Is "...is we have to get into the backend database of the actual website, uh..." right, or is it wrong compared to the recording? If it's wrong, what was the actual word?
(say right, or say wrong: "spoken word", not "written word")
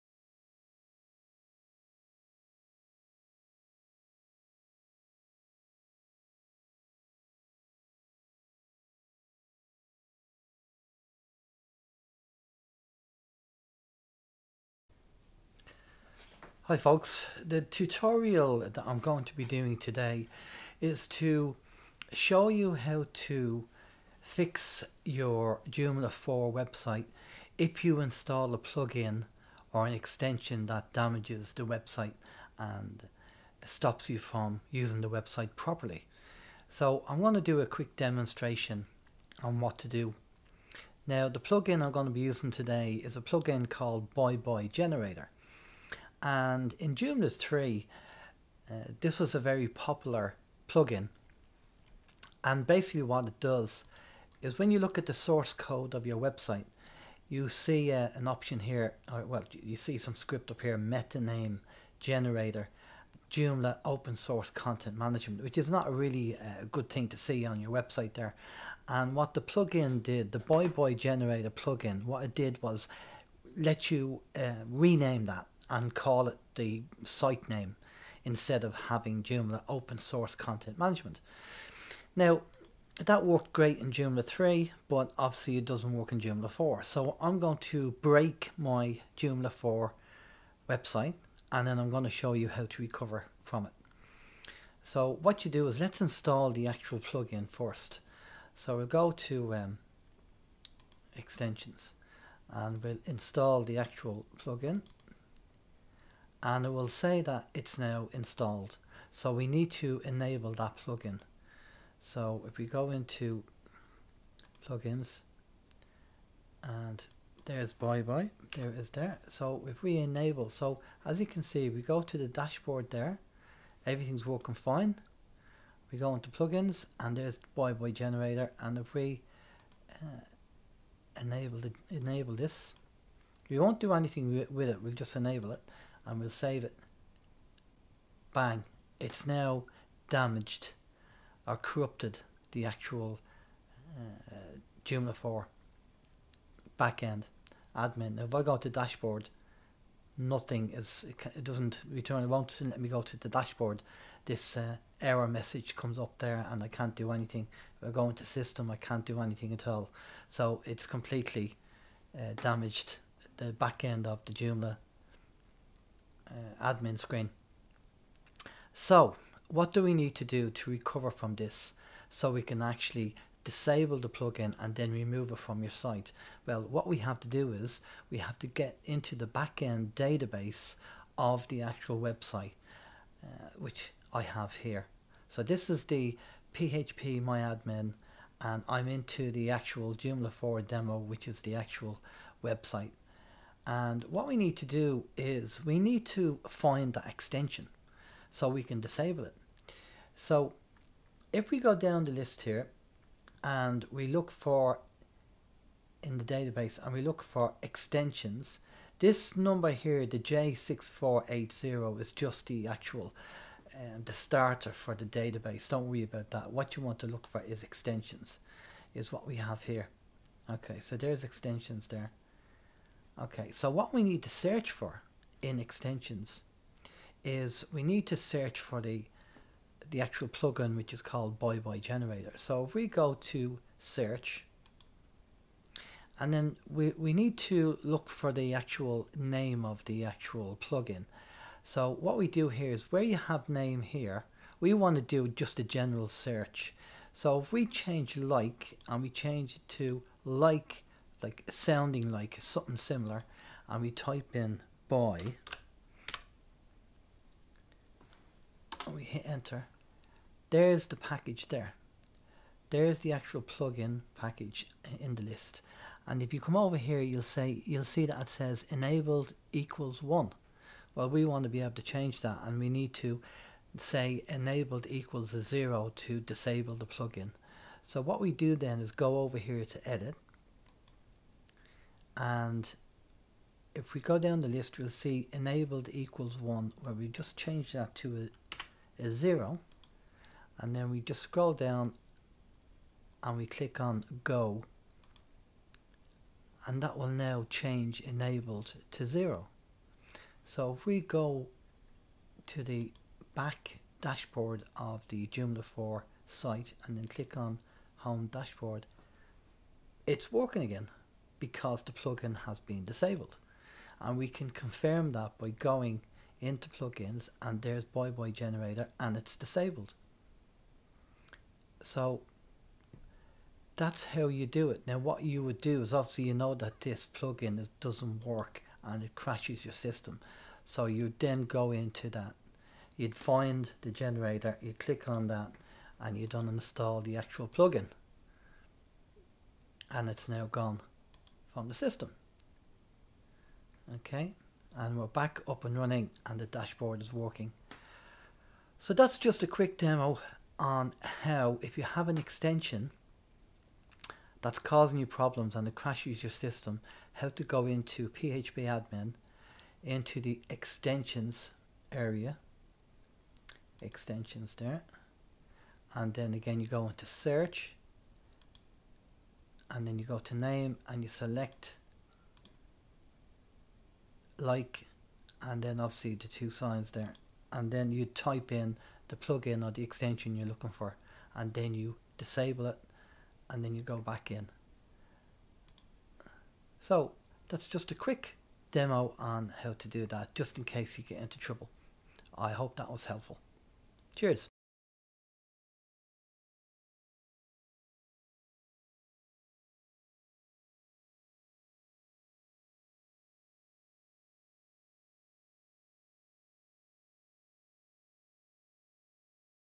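right.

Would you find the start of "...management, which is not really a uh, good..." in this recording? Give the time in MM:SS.
01:04.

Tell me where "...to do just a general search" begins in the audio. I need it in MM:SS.
04:04.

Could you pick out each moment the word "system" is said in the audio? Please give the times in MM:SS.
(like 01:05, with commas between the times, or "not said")
02:38, 05:29, 05:41, 05:56.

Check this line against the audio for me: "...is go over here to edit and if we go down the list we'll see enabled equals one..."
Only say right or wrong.
right.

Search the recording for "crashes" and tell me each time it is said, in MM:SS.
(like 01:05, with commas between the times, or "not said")
05:29, 05:55.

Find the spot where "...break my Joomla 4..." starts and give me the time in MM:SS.
01:28.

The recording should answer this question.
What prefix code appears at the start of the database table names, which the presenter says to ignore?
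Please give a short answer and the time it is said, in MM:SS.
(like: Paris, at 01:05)
J6480, at 03:30.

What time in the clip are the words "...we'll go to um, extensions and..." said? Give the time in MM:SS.
01:38.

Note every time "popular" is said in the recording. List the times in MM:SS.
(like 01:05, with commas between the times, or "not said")
00:49.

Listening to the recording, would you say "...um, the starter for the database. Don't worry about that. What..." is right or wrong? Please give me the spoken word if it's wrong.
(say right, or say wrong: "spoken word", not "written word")
right.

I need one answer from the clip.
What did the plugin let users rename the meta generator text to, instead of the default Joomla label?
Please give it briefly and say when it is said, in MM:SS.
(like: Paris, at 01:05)
the site name, at 01:17.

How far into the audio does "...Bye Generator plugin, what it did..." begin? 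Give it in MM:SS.
01:10.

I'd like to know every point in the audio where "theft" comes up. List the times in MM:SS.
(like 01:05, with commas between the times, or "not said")
not said.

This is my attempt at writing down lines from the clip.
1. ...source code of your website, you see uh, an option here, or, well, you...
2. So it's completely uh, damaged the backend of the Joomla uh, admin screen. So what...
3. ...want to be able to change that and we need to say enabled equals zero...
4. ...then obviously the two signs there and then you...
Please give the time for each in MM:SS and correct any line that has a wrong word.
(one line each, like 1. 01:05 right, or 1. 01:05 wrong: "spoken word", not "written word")
1. 00:55 right
2. 02:40 right
3. 04:31 right
4. 06:15 right.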